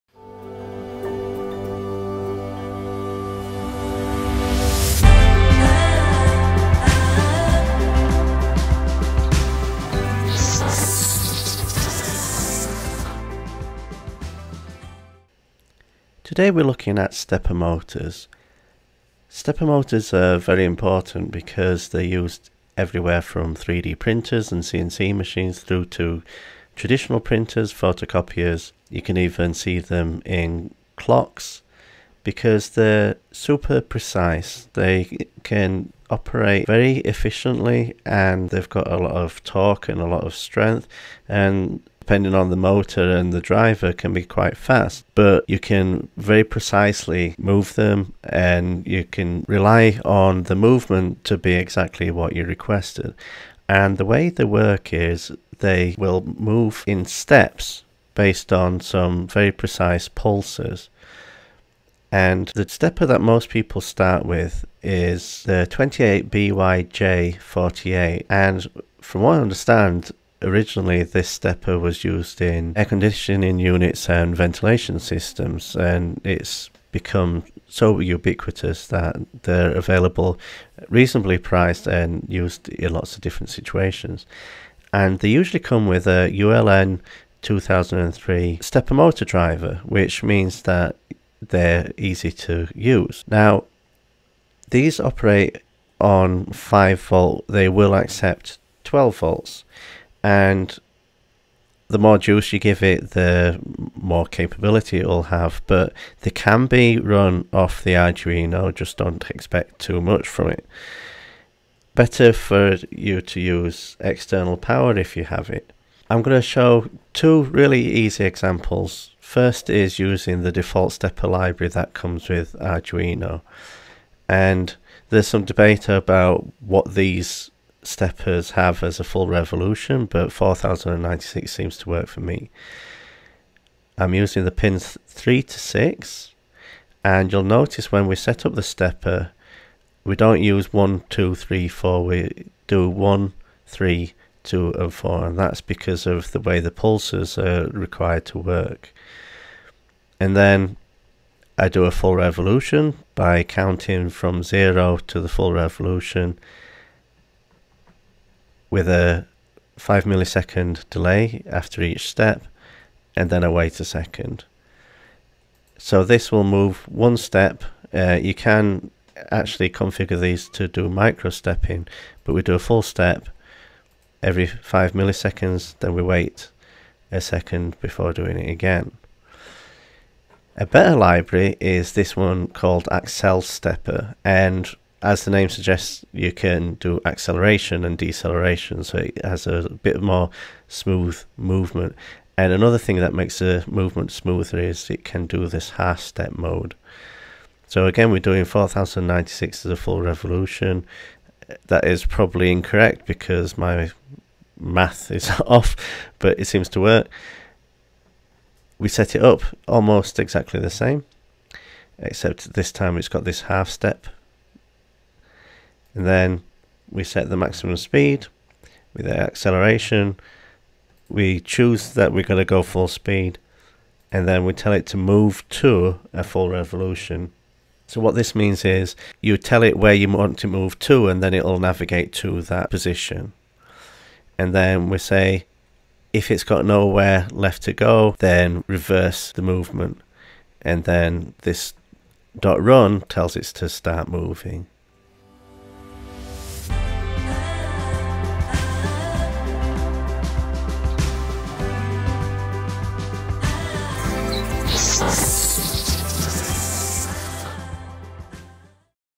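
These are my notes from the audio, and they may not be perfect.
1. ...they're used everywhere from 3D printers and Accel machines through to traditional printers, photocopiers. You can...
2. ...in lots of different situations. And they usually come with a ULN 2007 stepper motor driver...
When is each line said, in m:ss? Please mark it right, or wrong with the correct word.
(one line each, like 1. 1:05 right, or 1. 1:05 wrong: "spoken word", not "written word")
1. 0:21 wrong: "CNC", not "Accel"
2. 1:22 wrong: "2003", not "2007".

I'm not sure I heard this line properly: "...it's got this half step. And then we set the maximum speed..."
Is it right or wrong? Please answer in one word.
right.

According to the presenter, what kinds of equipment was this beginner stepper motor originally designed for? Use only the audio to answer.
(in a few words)
Air conditioning units.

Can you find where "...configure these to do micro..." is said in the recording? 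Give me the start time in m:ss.
2:49.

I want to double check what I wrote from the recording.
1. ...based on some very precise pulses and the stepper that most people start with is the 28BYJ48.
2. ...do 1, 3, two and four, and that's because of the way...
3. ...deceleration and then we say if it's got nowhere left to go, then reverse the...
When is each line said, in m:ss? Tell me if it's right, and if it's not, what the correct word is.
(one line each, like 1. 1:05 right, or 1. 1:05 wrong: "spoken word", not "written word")
1. 0:58 right
2. 2:22 right
3. 3:52 wrong: "position", not "deceleration".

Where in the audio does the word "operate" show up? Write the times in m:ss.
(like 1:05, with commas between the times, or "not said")
0:36, 1:34.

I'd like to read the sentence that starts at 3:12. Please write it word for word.
And another thing that makes the movement smoother is it can do this half step mode.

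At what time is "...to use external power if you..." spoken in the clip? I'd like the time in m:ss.
1:53.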